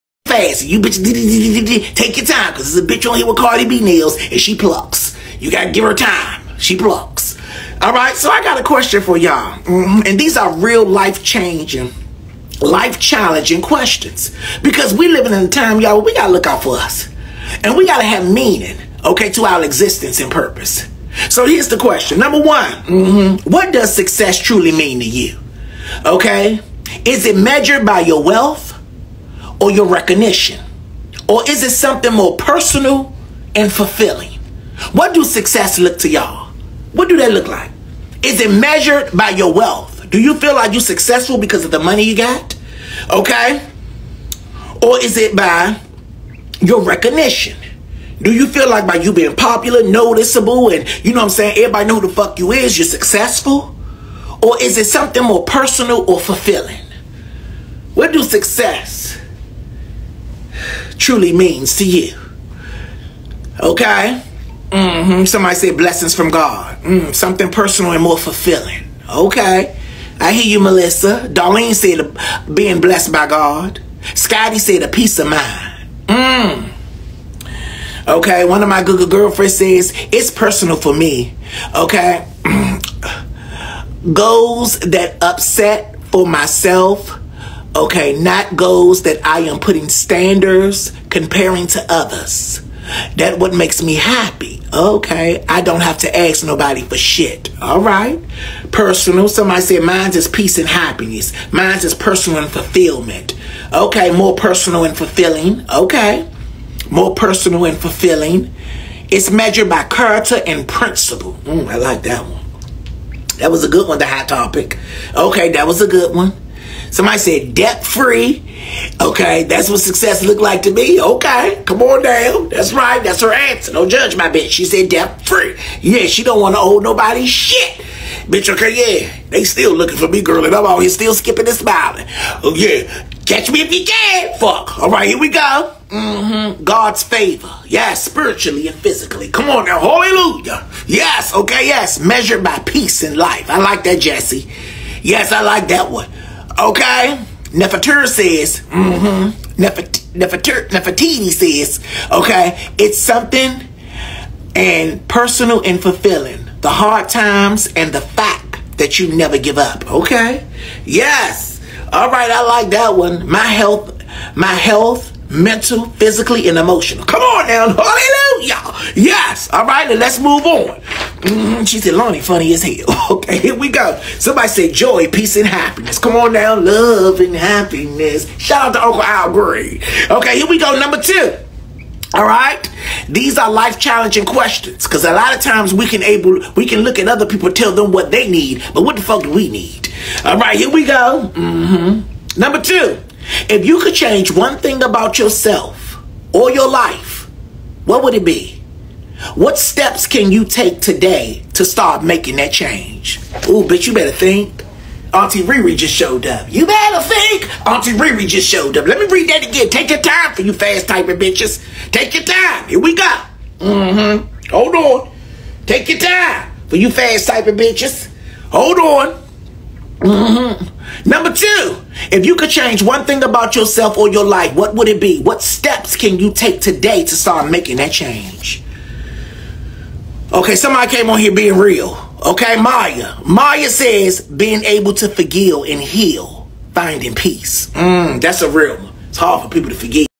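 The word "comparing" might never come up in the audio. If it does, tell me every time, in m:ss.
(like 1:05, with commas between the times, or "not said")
1:31.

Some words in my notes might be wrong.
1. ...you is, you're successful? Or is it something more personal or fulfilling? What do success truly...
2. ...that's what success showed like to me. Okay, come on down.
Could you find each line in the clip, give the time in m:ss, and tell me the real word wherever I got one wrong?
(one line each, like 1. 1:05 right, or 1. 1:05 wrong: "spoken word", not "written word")
1. 0:52 right
2. 1:59 wrong: "looked", not "showed".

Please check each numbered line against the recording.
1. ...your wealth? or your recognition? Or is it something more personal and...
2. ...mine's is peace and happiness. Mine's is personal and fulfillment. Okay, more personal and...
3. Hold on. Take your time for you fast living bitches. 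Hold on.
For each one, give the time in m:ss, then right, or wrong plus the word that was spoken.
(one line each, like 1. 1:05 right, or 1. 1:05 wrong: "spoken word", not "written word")
1. 0:28 right
2. 1:39 right
3. 3:34 wrong: "typing", not "living".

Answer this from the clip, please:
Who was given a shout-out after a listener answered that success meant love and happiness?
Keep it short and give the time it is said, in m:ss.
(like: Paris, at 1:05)
Uncle Al Green, at 2:58.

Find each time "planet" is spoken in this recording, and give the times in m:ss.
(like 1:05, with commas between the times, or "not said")
not said.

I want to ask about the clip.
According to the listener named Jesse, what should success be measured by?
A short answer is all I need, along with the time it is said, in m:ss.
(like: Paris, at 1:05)
Peace in life, at 2:22.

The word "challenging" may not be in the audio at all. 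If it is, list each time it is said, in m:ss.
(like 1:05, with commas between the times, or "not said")
0:12, 3:03.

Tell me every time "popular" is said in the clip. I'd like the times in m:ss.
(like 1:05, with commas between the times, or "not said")
0:49.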